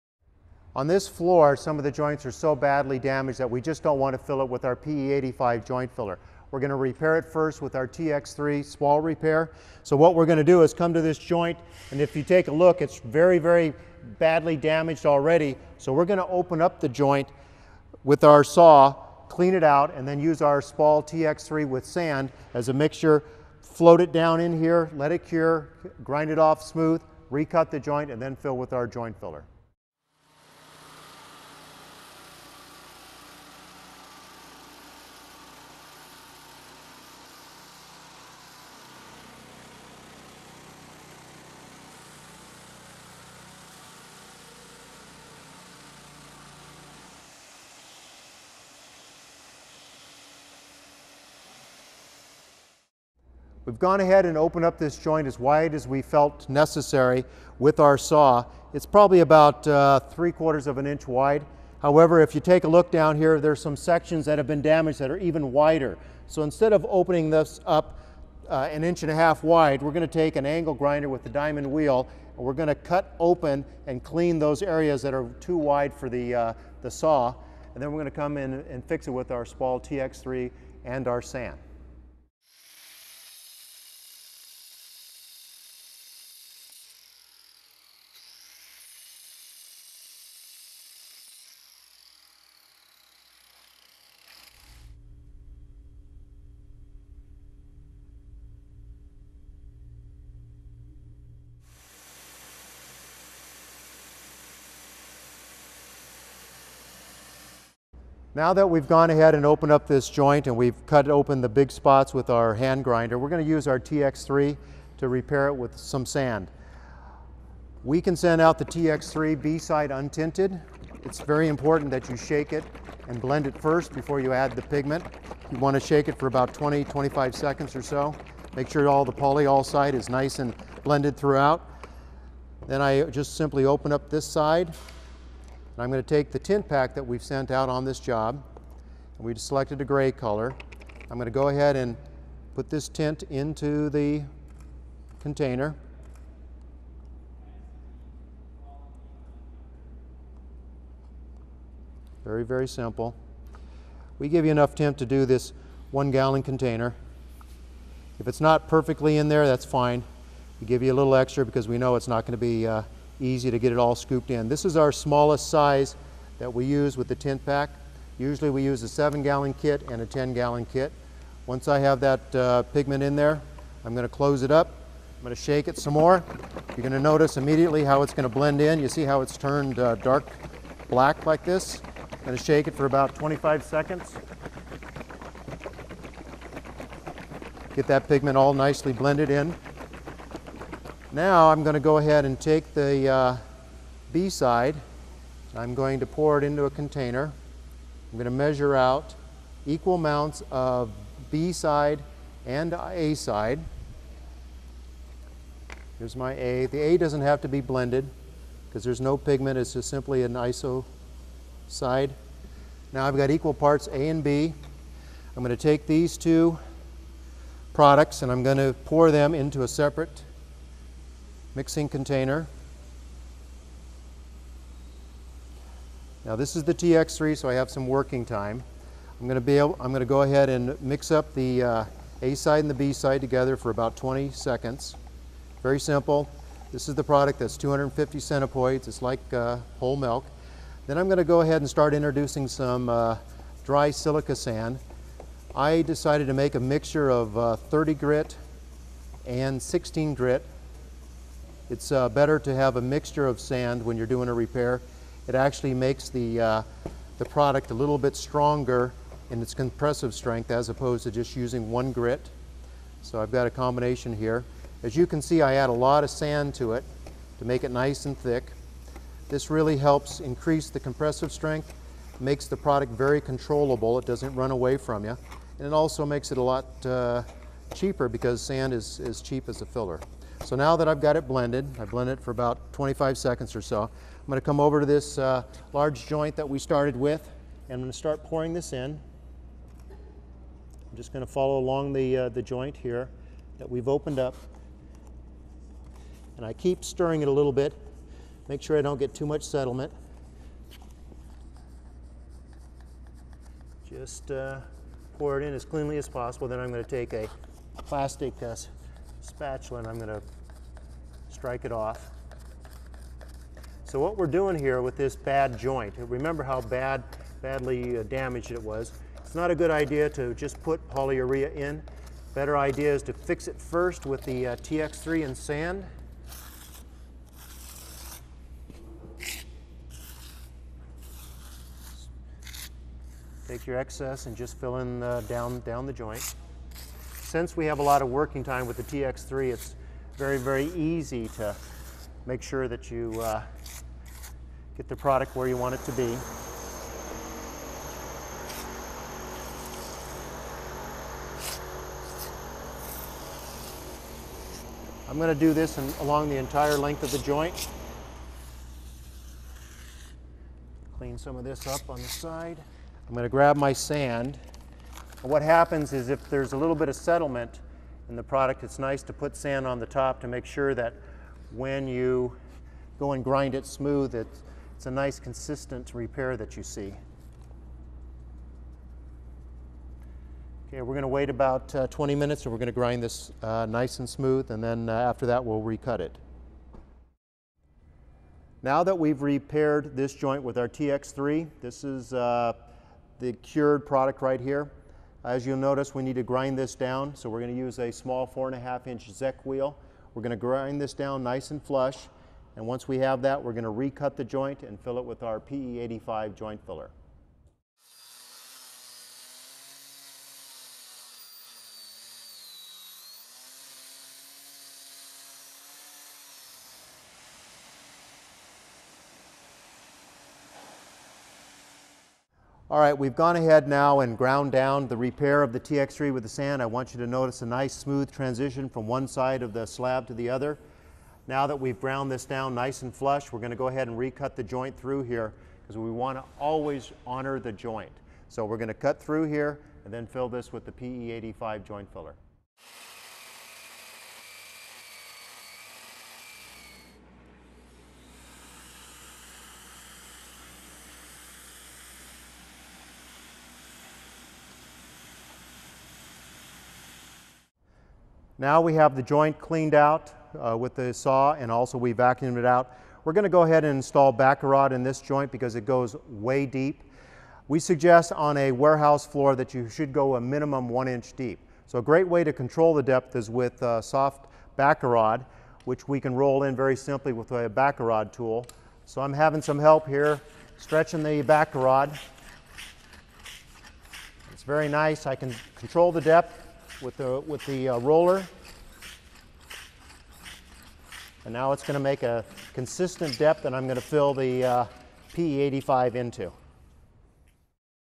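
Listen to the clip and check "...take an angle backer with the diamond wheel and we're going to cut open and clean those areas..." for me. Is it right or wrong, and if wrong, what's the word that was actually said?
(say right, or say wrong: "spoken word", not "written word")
wrong: "grinder", not "backer".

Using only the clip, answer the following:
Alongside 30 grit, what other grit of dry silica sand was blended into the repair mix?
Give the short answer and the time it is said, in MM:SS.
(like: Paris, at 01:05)
16 grit, at 04:09.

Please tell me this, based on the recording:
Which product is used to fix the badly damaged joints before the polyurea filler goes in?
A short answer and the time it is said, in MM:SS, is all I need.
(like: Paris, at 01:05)
TX3 spall repair, at 00:07.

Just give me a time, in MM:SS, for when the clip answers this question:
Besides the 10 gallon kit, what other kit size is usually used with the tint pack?
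02:48.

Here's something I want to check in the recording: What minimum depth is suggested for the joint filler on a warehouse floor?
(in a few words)
1 inch.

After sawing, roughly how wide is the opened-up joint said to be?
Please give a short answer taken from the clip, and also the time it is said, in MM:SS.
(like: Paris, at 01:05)
3/4 inch, at 00:59.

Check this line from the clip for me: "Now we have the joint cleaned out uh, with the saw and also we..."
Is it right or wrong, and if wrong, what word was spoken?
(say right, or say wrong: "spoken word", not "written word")
right.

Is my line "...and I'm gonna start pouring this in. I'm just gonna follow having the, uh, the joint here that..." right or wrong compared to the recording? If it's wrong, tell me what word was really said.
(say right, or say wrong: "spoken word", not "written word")
wrong: "along", not "having".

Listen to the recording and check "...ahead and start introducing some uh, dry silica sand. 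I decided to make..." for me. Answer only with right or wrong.
right.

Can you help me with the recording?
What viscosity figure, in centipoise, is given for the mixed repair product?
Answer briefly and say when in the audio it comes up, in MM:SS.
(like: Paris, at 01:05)
250, at 03:57.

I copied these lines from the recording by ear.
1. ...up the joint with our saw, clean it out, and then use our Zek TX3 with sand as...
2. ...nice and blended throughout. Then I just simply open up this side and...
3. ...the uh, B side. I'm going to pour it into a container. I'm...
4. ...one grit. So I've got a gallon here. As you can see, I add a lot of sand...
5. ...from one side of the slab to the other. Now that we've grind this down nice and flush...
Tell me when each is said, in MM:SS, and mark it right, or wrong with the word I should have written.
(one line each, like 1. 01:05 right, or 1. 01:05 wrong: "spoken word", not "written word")
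1. 00:16 wrong: "Spall", not "Zek"
2. 02:10 right
3. 03:12 right
4. 04:21 wrong: "combination", not "gallon"
5. 07:08 wrong: "ground", not "grind".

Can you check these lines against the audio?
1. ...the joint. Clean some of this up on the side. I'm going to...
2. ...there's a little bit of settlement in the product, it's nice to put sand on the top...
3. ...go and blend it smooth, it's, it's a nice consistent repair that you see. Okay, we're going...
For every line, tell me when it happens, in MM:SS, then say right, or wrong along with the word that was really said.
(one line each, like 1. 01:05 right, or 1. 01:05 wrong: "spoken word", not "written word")
1. 05:57 right
2. 06:06 right
3. 06:12 wrong: "grind", not "blend".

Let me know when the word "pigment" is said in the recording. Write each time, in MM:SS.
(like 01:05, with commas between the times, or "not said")
02:04, 02:52, 03:08, 03:29.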